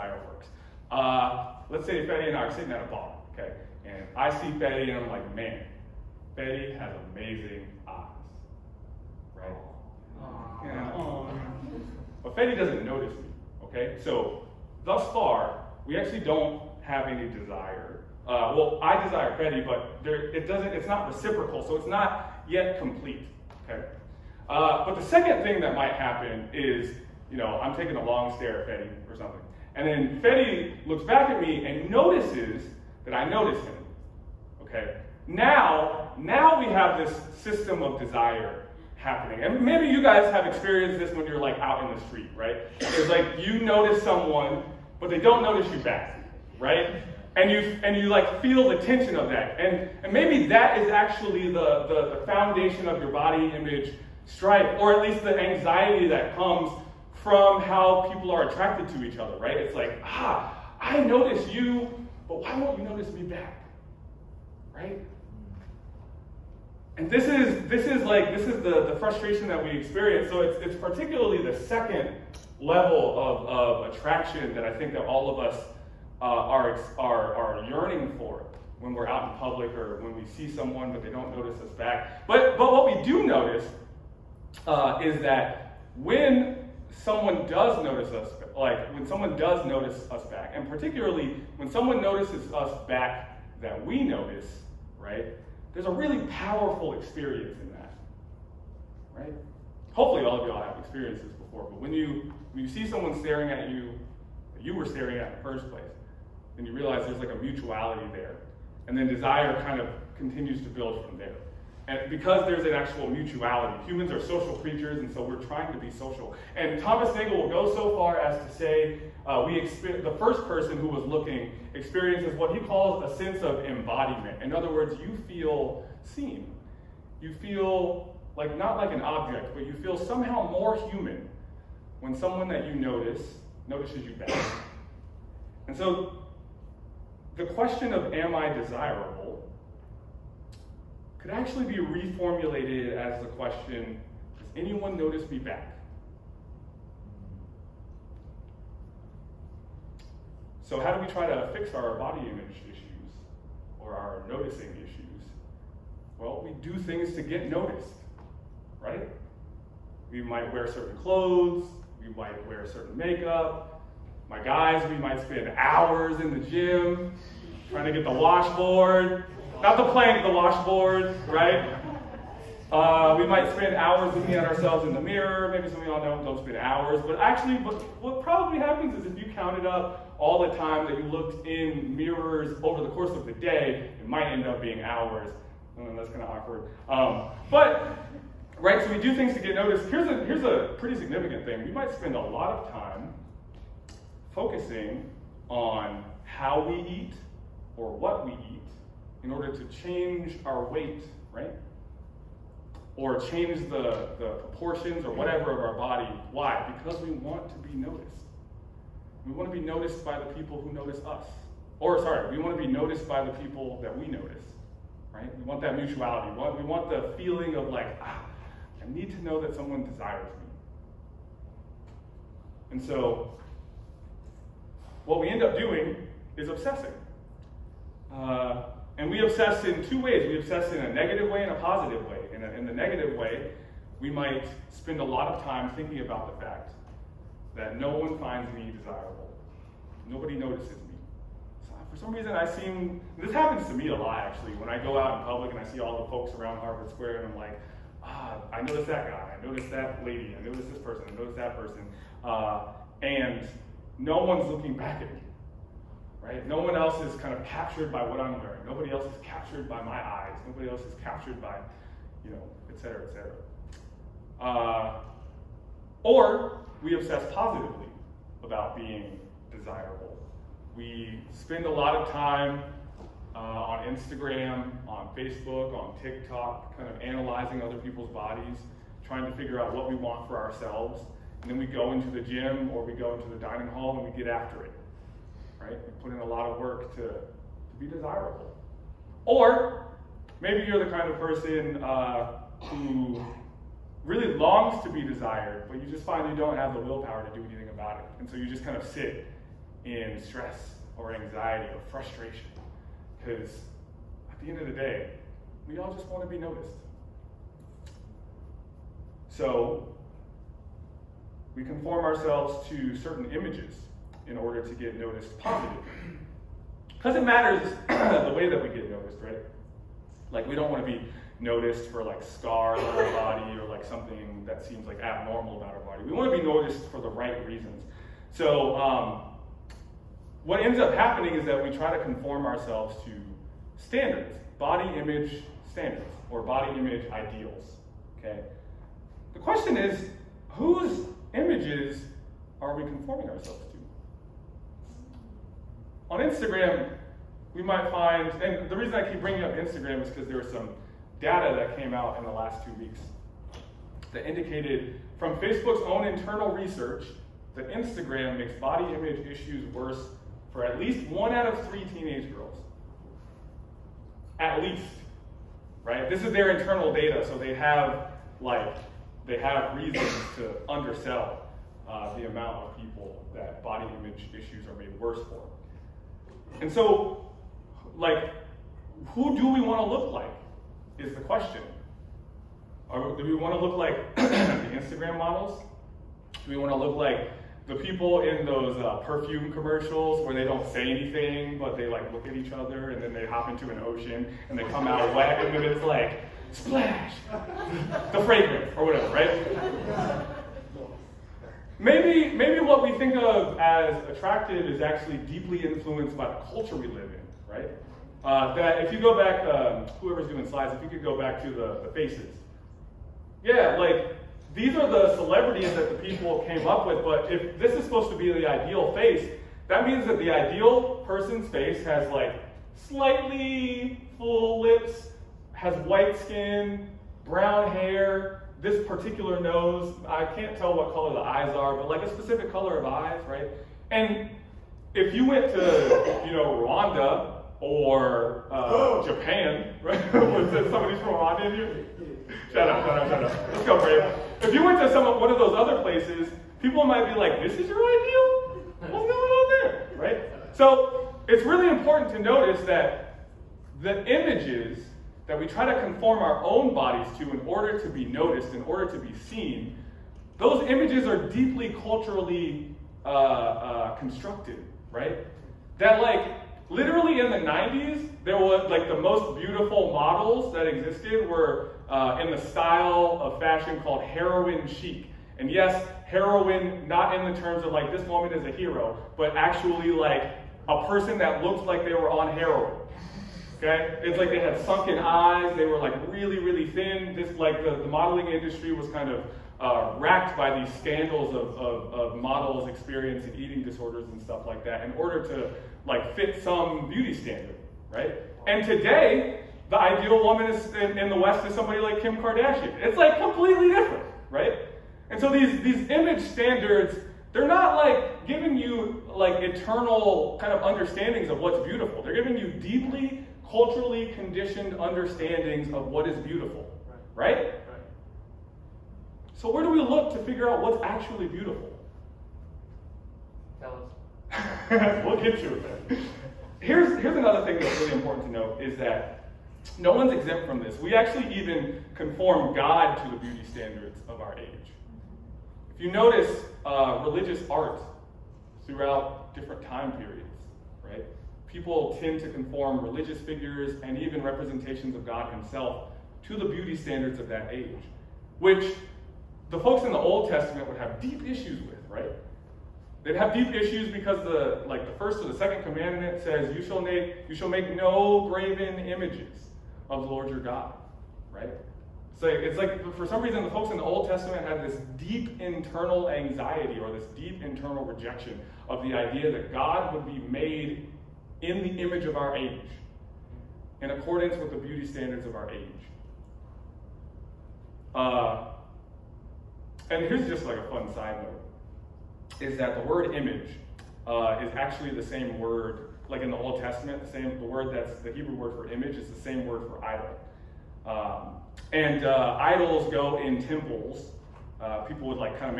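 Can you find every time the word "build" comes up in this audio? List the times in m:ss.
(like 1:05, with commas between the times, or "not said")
1:50.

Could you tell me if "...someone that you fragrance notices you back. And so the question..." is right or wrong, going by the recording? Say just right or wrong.
wrong.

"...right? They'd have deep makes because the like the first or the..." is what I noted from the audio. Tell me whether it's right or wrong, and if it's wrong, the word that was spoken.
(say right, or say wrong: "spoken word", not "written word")
wrong: "issues", not "makes".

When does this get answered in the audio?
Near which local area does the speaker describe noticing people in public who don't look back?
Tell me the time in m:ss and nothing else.
4:06.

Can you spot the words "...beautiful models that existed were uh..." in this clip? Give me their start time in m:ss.
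7:49.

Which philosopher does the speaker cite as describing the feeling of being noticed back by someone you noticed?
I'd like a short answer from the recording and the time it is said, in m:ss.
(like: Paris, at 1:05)
Thomas Nagel, at 1:56.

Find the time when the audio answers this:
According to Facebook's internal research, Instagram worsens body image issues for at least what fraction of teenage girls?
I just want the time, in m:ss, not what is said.
6:01.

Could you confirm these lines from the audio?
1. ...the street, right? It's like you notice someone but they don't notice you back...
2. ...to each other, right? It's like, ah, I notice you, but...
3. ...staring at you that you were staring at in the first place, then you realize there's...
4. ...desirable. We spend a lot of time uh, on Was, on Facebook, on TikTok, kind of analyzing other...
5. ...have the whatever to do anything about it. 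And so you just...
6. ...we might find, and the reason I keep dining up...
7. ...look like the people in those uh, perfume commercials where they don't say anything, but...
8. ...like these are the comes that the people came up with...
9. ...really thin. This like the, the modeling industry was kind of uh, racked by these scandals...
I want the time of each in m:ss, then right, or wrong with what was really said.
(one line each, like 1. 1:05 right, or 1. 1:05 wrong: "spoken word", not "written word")
1. 0:41 right
2. 0:58 right
3. 1:43 right
4. 4:29 wrong: "Instagram", not "Was"
5. 4:56 wrong: "willpower", not "whatever"
6. 5:47 wrong: "bringing", not "dining"
7. 6:26 right
8. 6:53 wrong: "celebrities", not "comes"
9. 8:06 right.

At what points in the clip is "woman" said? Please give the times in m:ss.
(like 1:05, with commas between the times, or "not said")
7:58, 8:20.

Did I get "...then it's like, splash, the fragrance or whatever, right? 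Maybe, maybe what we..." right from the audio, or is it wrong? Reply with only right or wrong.
right.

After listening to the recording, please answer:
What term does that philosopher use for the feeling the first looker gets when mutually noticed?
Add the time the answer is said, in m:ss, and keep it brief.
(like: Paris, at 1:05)
embodiment, at 2:03.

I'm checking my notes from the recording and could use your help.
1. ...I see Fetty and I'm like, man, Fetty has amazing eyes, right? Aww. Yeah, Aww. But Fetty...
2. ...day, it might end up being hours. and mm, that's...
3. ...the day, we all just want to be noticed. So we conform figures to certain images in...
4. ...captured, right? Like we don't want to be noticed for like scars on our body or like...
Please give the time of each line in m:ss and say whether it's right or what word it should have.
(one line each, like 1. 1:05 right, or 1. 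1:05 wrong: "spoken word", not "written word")
1. 0:04 right
2. 3:03 right
3. 5:04 wrong: "ourselves", not "figures"
4. 5:18 wrong: "noticed", not "captured".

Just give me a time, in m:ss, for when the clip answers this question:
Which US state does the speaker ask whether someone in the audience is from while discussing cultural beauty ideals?
7:21.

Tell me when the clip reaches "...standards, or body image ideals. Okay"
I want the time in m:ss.
5:35.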